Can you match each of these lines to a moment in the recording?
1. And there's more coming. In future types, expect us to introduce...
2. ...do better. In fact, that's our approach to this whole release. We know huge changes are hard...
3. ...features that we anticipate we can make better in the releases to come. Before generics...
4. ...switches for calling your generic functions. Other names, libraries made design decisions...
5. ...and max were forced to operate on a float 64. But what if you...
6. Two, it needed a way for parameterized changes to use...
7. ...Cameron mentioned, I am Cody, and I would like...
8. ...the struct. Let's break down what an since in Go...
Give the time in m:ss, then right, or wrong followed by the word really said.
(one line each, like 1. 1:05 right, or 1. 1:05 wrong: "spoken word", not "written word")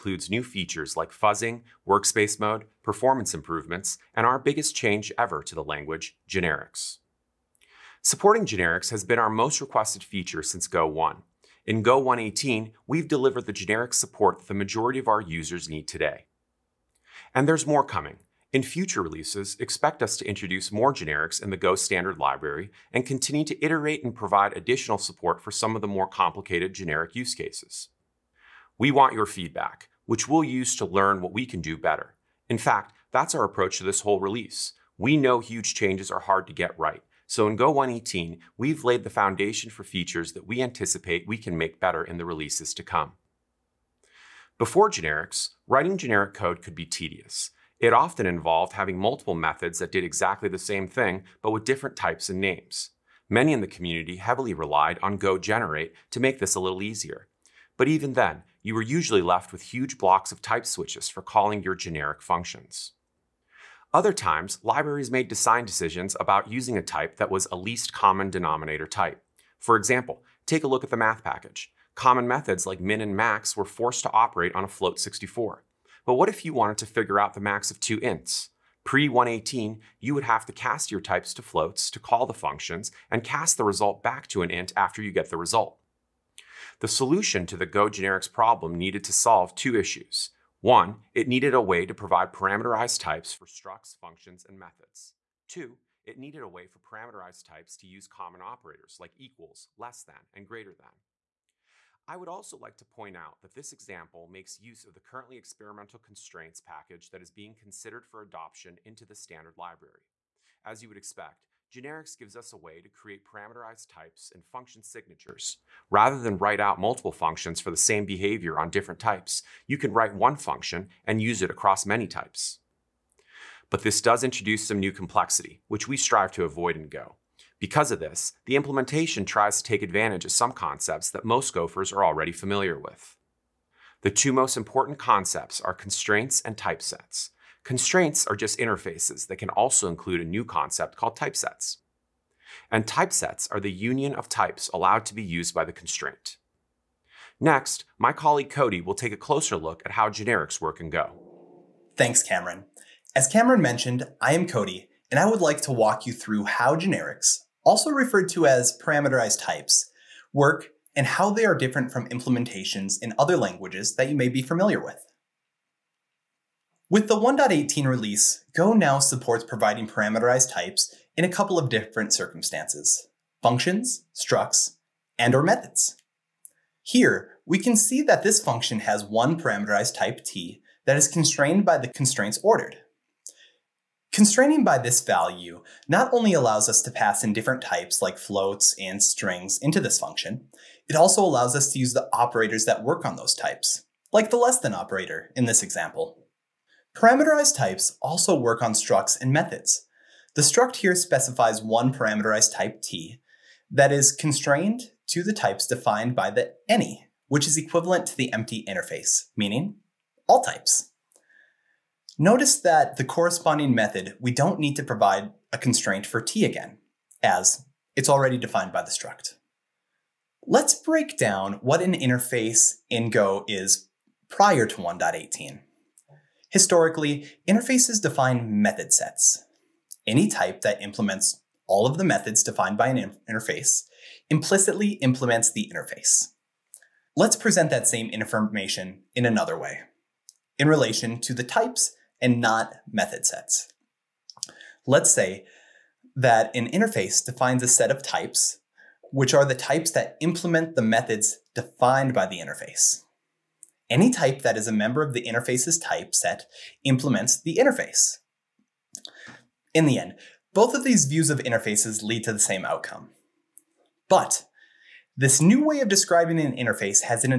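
1. 0:17 wrong: "releases", not "types"
2. 0:31 right
3. 0:39 right
4. 1:00 wrong: "times", not "names"
5. 1:13 right
6. 1:35 wrong: "types", not "changes"
7. 2:33 right
8. 3:38 wrong: "interface", not "since".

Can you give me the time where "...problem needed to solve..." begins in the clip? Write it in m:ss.
1:28.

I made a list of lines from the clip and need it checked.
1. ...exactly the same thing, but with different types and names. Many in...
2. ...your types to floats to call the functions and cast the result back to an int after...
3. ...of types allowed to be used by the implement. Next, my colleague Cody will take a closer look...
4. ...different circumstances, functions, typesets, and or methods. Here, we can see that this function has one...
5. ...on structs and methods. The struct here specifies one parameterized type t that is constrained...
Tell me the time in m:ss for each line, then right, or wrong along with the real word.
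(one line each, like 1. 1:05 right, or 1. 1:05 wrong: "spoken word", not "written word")
1. 0:50 right
2. 1:20 right
3. 2:24 wrong: "constraint", not "implement"
4. 2:51 wrong: "structs", not "typesets"
5. 3:18 right.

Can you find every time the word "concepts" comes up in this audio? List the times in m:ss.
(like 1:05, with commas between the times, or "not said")
2:10, 2:14, 2:20.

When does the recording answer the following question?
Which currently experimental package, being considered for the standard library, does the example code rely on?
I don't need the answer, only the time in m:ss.
1:45.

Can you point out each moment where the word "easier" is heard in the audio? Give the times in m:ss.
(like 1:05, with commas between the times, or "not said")
0:56.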